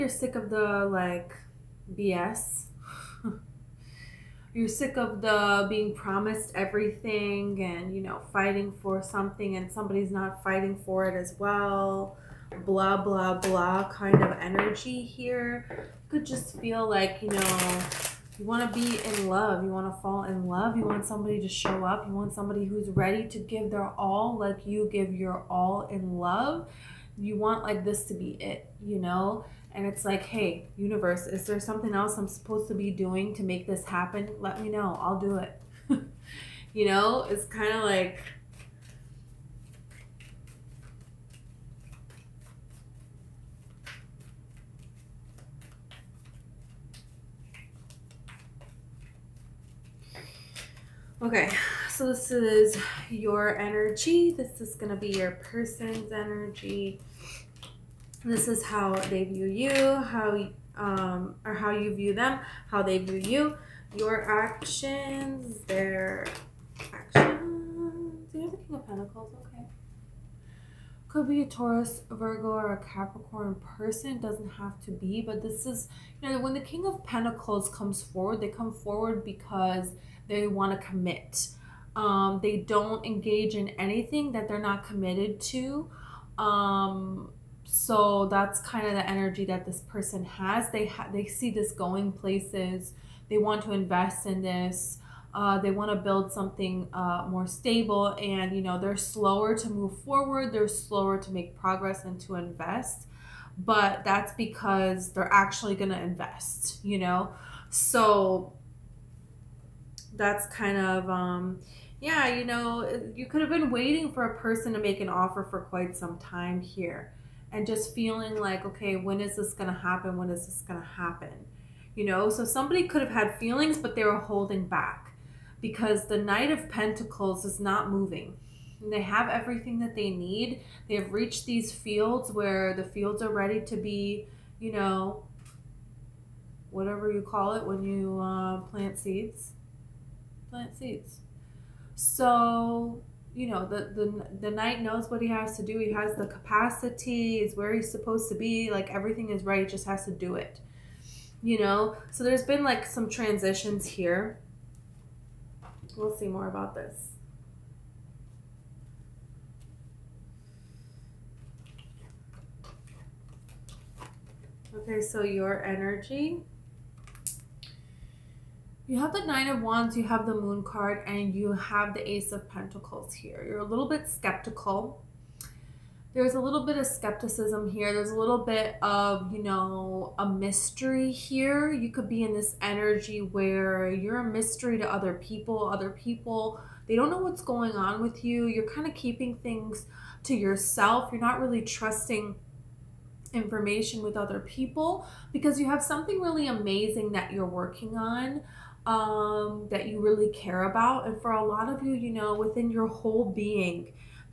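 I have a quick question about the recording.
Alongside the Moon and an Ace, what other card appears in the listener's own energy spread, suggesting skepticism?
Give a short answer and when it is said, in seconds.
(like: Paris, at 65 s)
Nine of Wands, at 169 s.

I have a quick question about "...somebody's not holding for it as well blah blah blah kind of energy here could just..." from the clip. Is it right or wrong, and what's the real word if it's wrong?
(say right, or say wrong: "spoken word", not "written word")
wrong: "fighting", not "holding".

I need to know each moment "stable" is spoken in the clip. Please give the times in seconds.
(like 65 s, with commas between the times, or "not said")
97 s.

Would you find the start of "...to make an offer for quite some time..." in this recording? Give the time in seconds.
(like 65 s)
114 s.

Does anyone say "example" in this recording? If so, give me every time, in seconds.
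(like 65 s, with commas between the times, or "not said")
not said.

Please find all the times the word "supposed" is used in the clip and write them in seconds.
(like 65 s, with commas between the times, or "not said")
32 s, 147 s.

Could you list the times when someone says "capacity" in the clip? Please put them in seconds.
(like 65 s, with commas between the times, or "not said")
146 s.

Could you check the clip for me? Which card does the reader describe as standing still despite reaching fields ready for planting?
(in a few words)
Knight of Pentacles.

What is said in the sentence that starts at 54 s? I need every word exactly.
This is going to be your person's energy.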